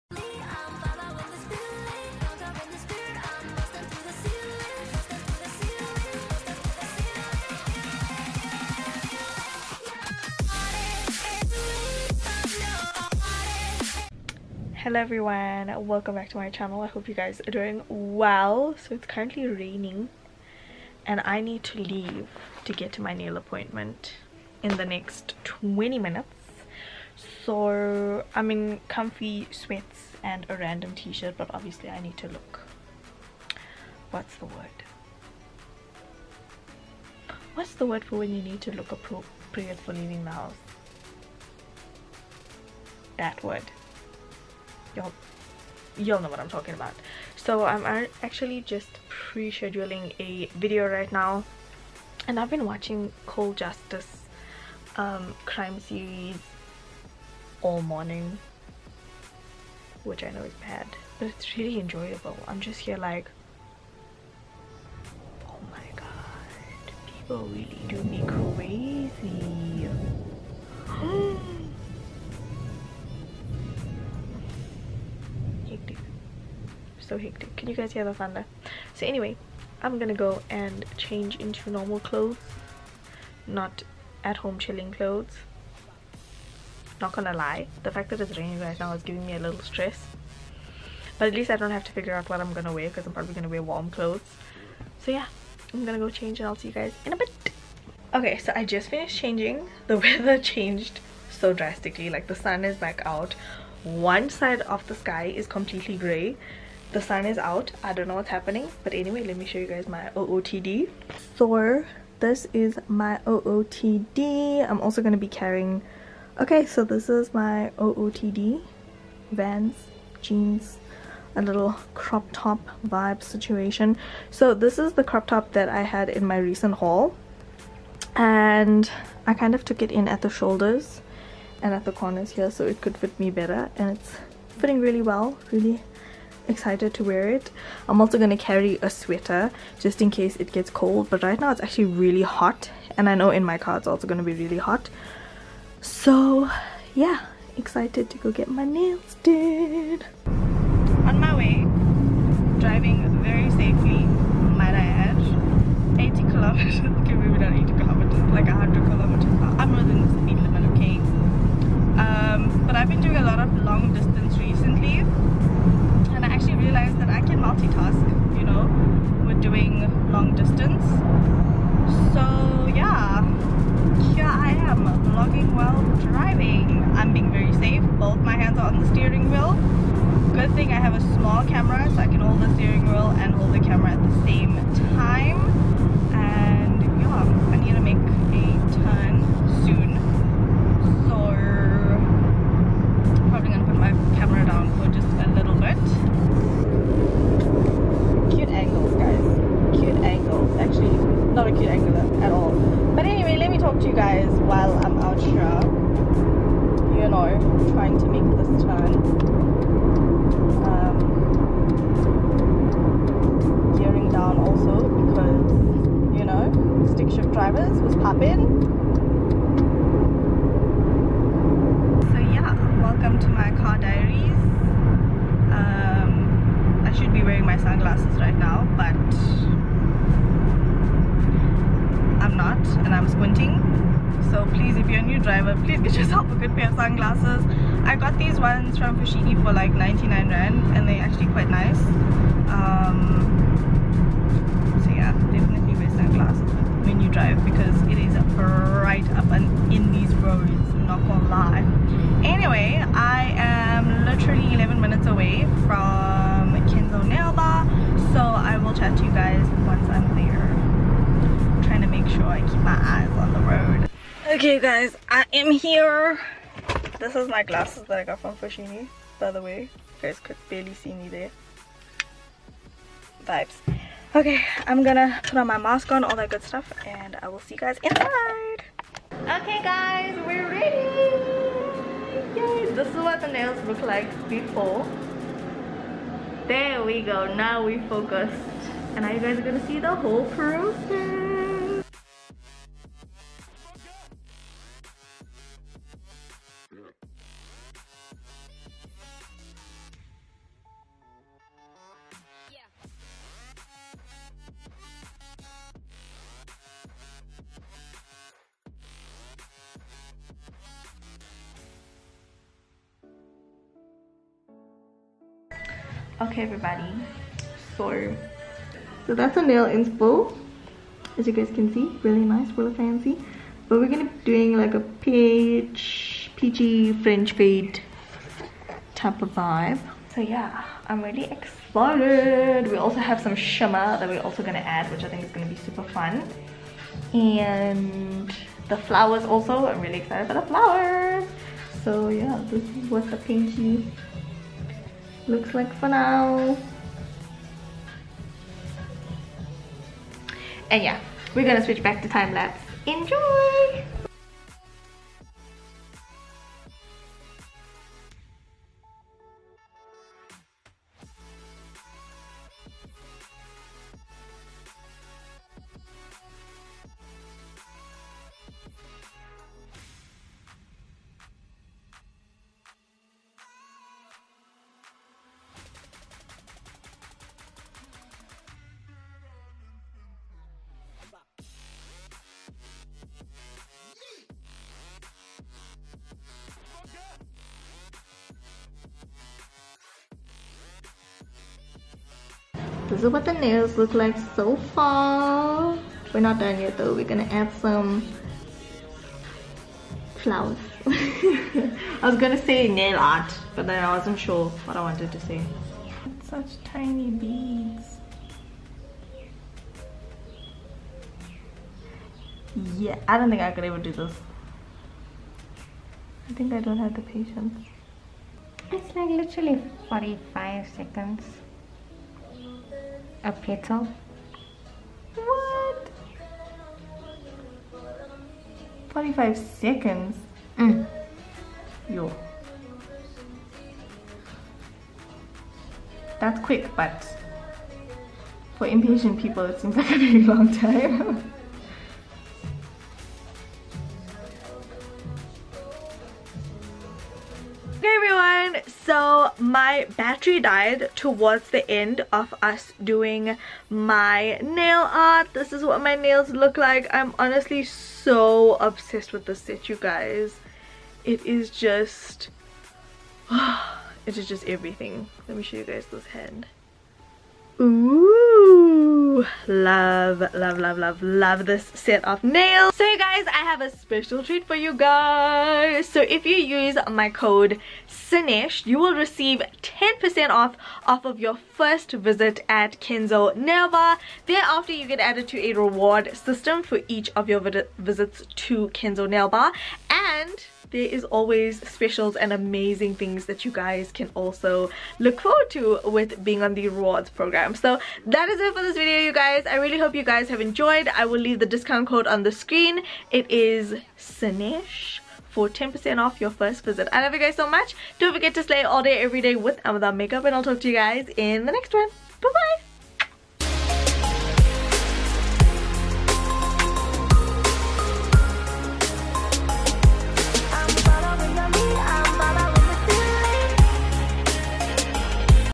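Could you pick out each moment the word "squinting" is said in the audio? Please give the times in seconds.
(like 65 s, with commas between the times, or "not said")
233 s.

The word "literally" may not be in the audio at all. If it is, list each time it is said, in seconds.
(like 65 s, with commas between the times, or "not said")
254 s, 419 s.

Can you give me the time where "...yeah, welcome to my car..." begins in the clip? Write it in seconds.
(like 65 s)
222 s.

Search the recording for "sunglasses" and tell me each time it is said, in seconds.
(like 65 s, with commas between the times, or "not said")
227 s, 236 s.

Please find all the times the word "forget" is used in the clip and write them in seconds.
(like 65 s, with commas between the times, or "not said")
508 s.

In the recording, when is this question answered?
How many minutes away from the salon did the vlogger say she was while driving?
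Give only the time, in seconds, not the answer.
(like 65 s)
254 s.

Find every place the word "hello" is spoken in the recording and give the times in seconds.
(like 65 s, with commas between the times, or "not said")
14 s.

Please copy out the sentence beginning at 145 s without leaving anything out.
So yeah, excited to go get my nails did.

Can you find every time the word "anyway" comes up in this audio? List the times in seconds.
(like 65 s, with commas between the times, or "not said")
79 s, 108 s, 203 s, 252 s.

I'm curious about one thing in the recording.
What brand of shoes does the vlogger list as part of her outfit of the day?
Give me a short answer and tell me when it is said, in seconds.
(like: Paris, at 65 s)
Vans, at 119 s.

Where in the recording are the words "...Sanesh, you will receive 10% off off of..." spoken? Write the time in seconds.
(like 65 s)
477 s.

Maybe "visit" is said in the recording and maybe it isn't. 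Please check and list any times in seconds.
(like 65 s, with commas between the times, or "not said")
481 s, 487 s, 506 s.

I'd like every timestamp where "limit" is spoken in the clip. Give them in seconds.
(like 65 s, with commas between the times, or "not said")
160 s.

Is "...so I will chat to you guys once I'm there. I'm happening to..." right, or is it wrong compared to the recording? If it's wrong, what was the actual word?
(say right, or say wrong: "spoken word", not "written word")
wrong: "trying", not "happening".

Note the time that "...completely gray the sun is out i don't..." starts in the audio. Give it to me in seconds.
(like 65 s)
105 s.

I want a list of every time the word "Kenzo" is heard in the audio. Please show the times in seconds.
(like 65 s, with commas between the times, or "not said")
256 s, 482 s, 488 s.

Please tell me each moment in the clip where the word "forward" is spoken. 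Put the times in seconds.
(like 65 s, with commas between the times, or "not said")
495 s.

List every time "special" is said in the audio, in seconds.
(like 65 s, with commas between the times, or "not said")
473 s, 491 s.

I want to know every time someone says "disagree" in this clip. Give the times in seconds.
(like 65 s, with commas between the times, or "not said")
not said.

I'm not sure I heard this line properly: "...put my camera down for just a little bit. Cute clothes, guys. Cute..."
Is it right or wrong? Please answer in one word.
wrong.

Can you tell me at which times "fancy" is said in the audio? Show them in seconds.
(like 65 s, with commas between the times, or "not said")
322 s.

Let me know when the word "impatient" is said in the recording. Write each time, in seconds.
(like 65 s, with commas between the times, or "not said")
438 s.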